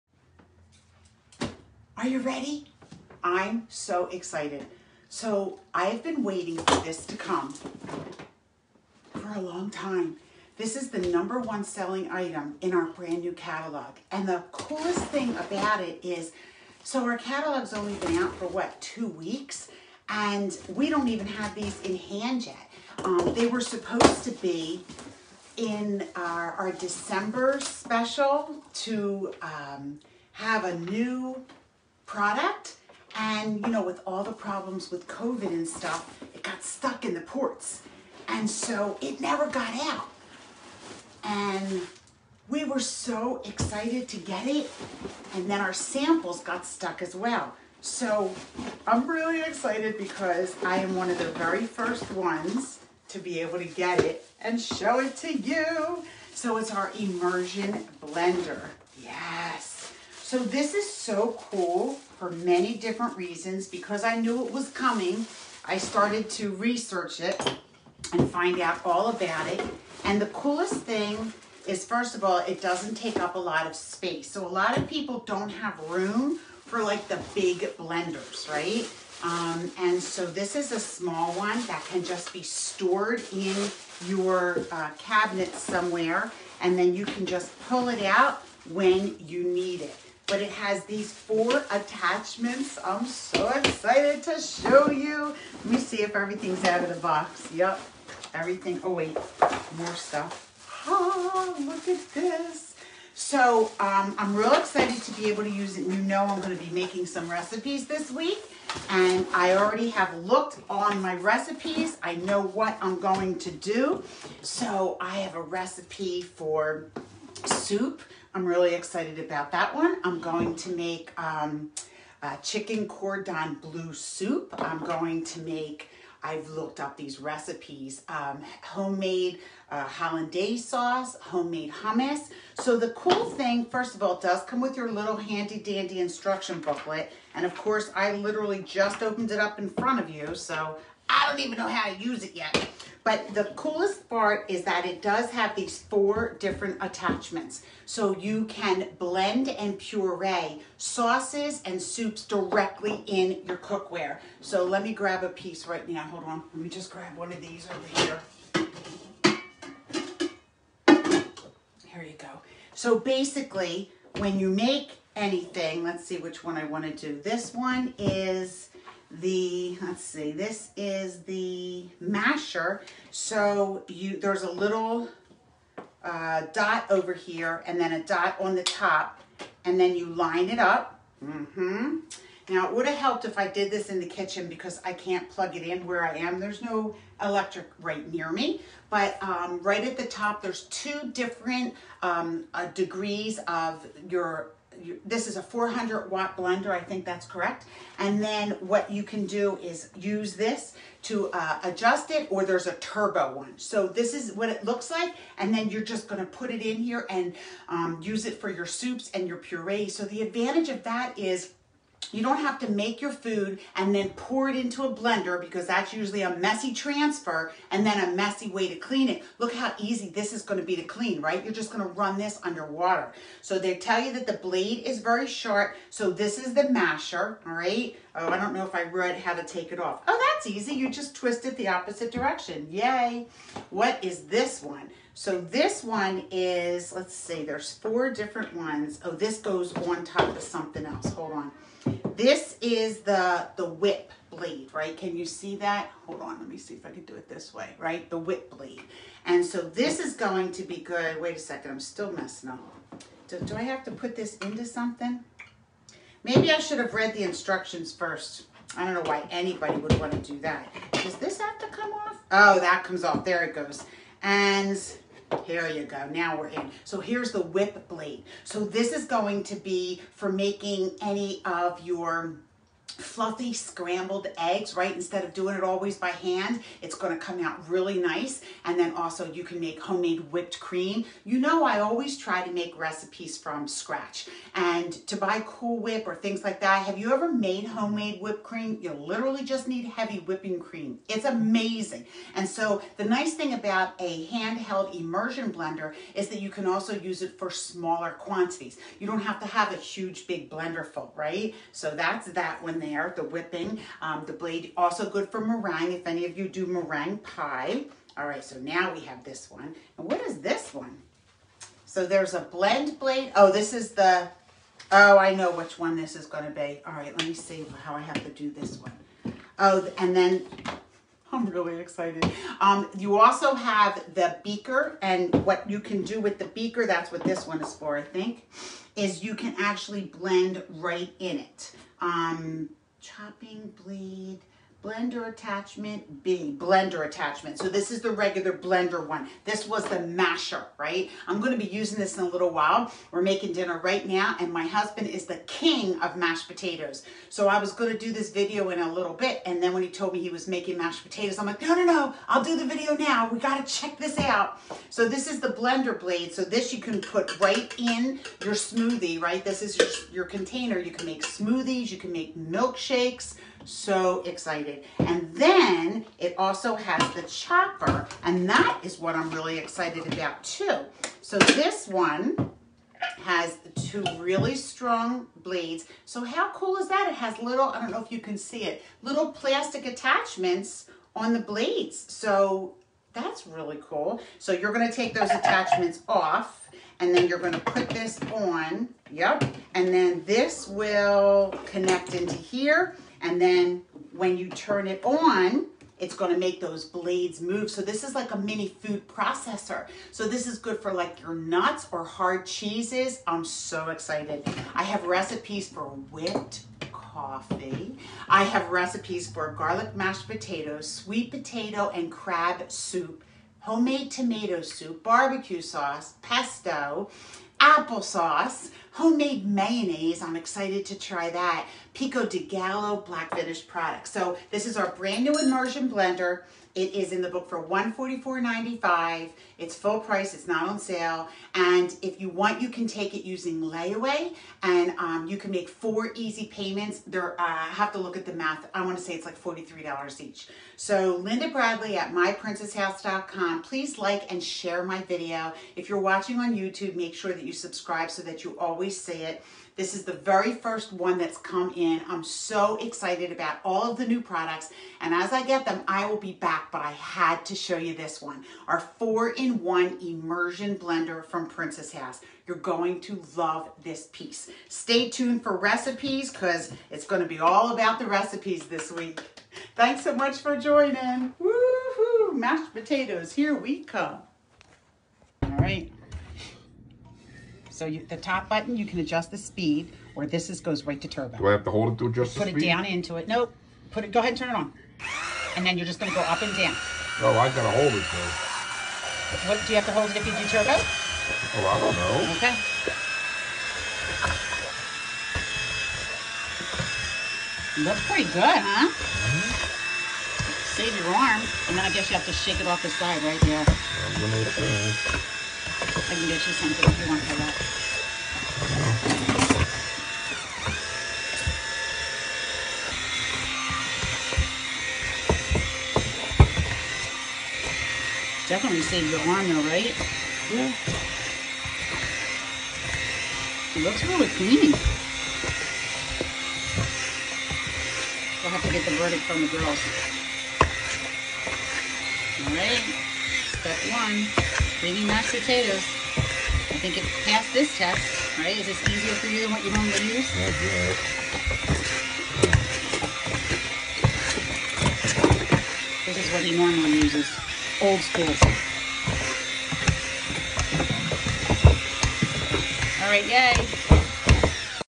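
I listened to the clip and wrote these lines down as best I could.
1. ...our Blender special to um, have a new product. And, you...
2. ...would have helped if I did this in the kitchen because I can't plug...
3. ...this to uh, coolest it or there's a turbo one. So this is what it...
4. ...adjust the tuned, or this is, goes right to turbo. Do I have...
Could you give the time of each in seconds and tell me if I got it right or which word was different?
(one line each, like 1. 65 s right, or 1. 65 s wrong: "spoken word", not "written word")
1. 26 s wrong: "December", not "Blender"
2. 182 s right
3. 200 s wrong: "adjust", not "coolest"
4. 478 s wrong: "speed", not "tuned".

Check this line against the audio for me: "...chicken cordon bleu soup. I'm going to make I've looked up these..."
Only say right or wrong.
right.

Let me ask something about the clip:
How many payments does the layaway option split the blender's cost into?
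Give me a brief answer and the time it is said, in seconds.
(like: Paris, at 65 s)
4, at 435 s.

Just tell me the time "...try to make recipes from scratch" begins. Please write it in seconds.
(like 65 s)
282 s.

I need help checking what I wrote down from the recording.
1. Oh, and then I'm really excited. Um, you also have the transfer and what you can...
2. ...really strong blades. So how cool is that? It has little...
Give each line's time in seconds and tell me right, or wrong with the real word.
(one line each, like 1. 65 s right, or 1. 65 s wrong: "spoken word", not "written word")
1. 319 s wrong: "beaker", not "transfer"
2. 374 s right.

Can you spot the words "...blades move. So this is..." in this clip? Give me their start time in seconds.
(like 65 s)
396 s.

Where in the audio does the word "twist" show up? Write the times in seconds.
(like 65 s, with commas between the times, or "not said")
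231 s.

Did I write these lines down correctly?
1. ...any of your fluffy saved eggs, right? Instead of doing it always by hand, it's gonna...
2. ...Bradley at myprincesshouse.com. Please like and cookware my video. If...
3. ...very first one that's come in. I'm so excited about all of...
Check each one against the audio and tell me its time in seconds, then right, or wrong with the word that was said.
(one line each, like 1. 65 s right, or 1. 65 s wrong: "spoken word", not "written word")
1. 271 s wrong: "scrambled", not "saved"
2. 441 s wrong: "share", not "cookware"
3. 450 s right.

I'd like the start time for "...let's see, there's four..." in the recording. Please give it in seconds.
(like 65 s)
236 s.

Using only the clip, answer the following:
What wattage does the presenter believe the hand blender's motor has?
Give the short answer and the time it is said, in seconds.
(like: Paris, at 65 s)
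400 watt, at 195 s.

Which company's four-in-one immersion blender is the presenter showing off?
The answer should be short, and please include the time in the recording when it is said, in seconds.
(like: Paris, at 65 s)
Princess House, at 461 s.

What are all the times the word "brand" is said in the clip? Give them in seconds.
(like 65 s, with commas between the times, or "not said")
12 s, 424 s.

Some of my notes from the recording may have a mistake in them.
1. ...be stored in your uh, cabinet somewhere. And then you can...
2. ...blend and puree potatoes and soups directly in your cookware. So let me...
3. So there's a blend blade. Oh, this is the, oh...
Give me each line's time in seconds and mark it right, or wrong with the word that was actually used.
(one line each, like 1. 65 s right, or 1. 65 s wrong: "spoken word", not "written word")
1. 82 s right
2. 148 s wrong: "sauces", not "potatoes"
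3. 311 s right.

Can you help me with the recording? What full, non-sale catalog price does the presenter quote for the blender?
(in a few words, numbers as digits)
$144.95.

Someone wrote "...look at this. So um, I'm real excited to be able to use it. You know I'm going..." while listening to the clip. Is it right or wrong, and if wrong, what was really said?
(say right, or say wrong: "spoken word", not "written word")
right.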